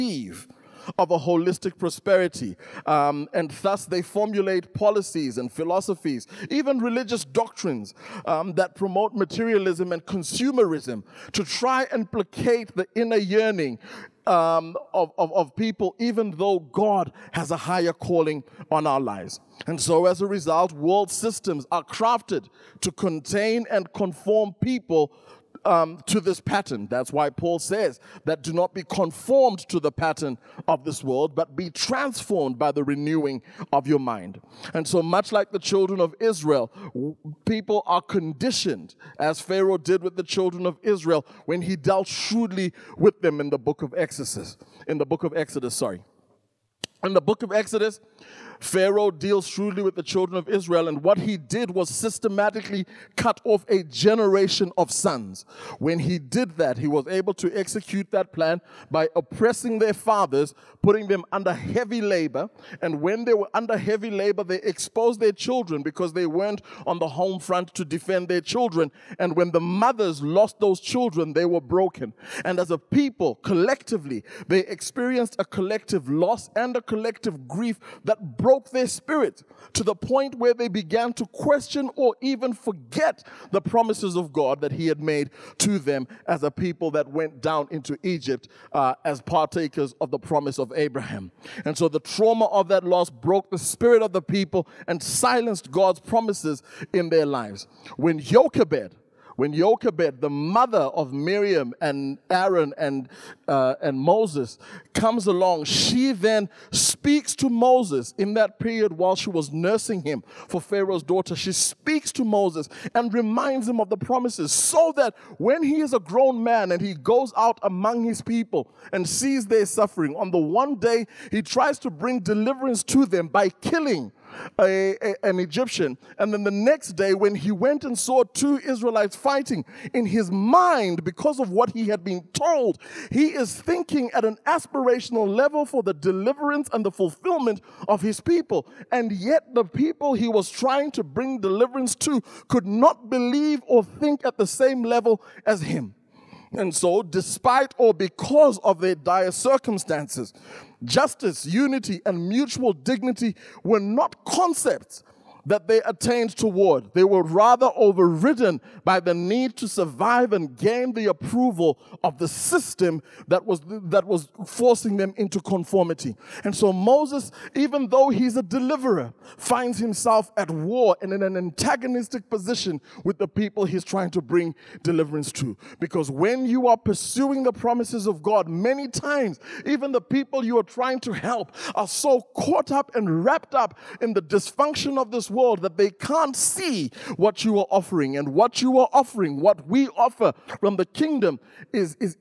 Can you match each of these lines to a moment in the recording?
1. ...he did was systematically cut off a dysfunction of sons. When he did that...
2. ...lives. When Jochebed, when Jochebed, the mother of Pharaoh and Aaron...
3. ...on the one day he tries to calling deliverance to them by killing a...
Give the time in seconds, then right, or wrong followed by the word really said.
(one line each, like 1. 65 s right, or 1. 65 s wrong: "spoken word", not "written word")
1. 51 s wrong: "generation", not "dysfunction"
2. 97 s wrong: "Miriam", not "Pharaoh"
3. 120 s wrong: "bring", not "calling".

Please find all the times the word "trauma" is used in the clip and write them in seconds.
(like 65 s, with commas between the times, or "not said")
91 s.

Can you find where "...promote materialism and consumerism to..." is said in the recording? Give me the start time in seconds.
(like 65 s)
8 s.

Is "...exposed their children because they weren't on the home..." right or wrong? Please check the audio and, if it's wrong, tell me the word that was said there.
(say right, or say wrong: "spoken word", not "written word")
right.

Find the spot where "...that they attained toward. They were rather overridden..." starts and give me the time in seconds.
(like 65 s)
155 s.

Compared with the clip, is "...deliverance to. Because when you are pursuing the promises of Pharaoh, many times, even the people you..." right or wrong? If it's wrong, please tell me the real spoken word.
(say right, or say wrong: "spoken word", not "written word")
wrong: "God", not "Pharaoh".